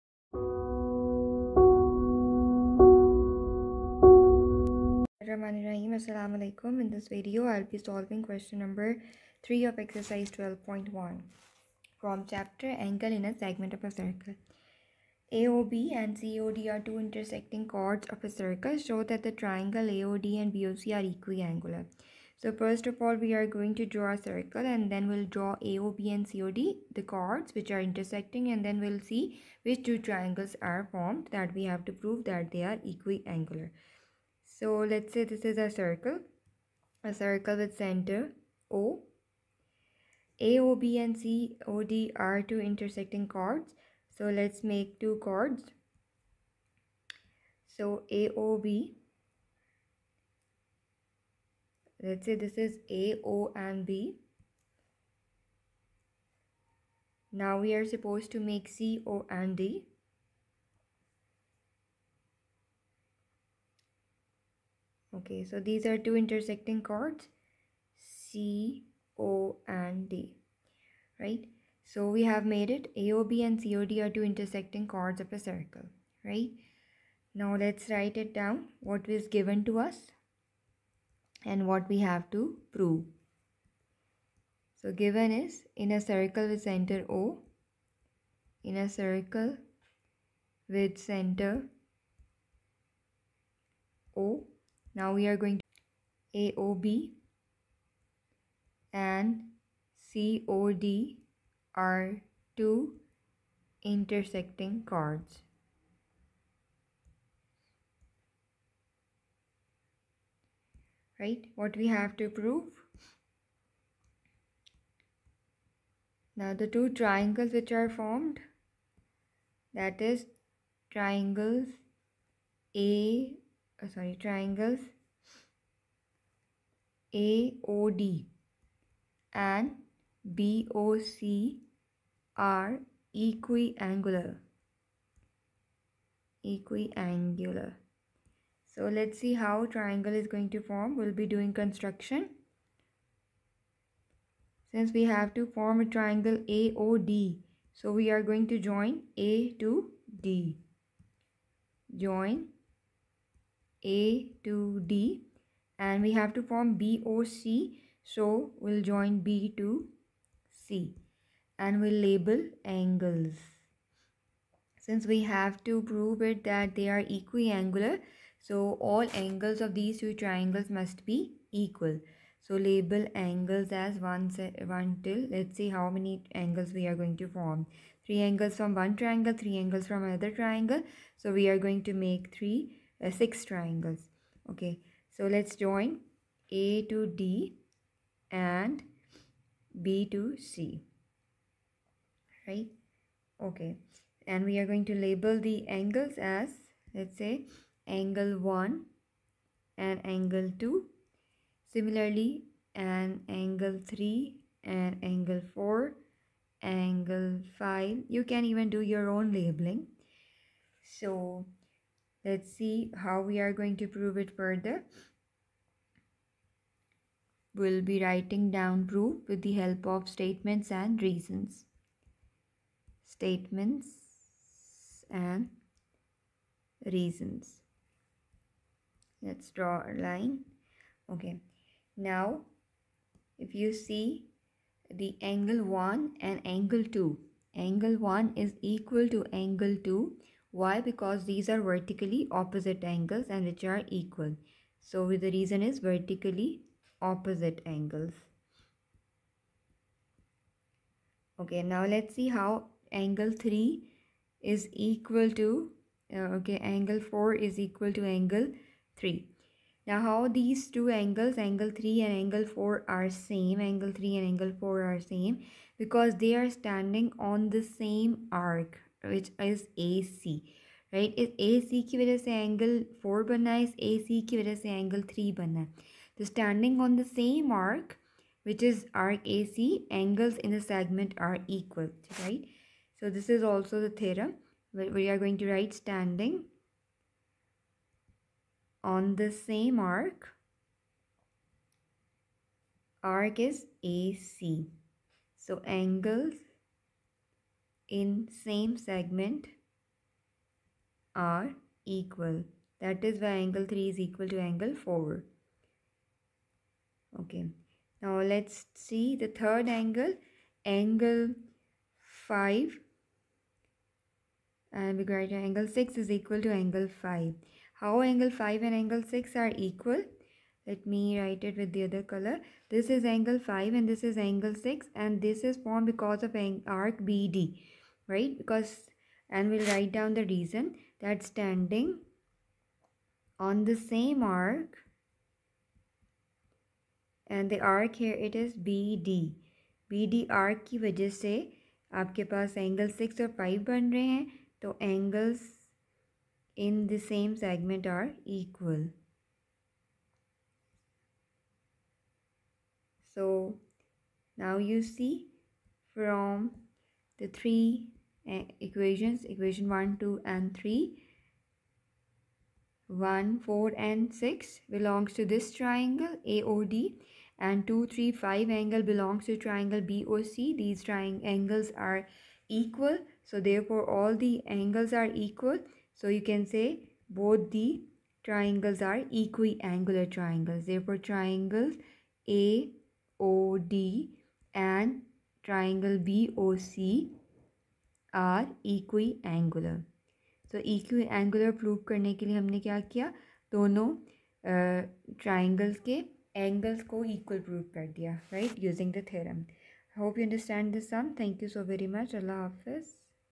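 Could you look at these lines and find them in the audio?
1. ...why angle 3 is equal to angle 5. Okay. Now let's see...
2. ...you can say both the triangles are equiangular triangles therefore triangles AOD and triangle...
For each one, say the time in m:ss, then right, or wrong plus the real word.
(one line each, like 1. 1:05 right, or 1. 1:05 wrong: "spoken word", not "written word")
1. 5:03 wrong: "4", not "5"
2. 6:16 right.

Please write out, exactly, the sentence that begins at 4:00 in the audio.
Because these are vertically opposite angles and which are equal.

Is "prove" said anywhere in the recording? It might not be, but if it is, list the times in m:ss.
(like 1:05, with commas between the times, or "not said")
0:31, 1:22, 1:52, 2:45, 3:33.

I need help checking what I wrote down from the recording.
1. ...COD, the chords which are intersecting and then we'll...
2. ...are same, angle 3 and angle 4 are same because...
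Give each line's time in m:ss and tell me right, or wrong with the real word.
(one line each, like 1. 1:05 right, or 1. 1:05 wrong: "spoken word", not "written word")
1. 0:26 right
2. 4:22 right.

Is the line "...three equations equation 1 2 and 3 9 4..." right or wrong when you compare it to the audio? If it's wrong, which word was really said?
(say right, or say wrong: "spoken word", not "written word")
wrong: "1", not "9".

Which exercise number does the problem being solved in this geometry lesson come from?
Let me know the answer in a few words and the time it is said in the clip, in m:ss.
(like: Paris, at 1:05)
12.1, at 0:09.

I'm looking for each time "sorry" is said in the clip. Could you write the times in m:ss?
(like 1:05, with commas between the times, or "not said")
2:03.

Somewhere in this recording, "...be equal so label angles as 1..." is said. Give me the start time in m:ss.
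2:51.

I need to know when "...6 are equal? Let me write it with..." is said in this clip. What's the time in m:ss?
5:19.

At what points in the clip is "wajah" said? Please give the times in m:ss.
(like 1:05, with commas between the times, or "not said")
5:40.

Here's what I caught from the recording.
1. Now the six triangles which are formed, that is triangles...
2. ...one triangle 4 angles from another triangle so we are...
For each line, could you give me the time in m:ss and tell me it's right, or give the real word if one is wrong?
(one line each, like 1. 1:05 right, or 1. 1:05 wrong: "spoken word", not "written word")
1. 1:56 wrong: "two", not "six"
2. 2:58 wrong: "3", not "4".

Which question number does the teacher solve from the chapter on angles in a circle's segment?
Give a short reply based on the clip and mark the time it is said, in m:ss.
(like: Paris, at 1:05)
3, at 0:08.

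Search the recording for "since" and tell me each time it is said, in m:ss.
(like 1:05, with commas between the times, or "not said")
2:24, 2:44.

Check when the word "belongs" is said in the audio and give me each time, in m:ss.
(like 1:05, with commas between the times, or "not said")
6:04, 6:08.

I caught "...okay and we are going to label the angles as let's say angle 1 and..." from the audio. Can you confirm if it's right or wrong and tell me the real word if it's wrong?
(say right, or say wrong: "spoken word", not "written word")
right.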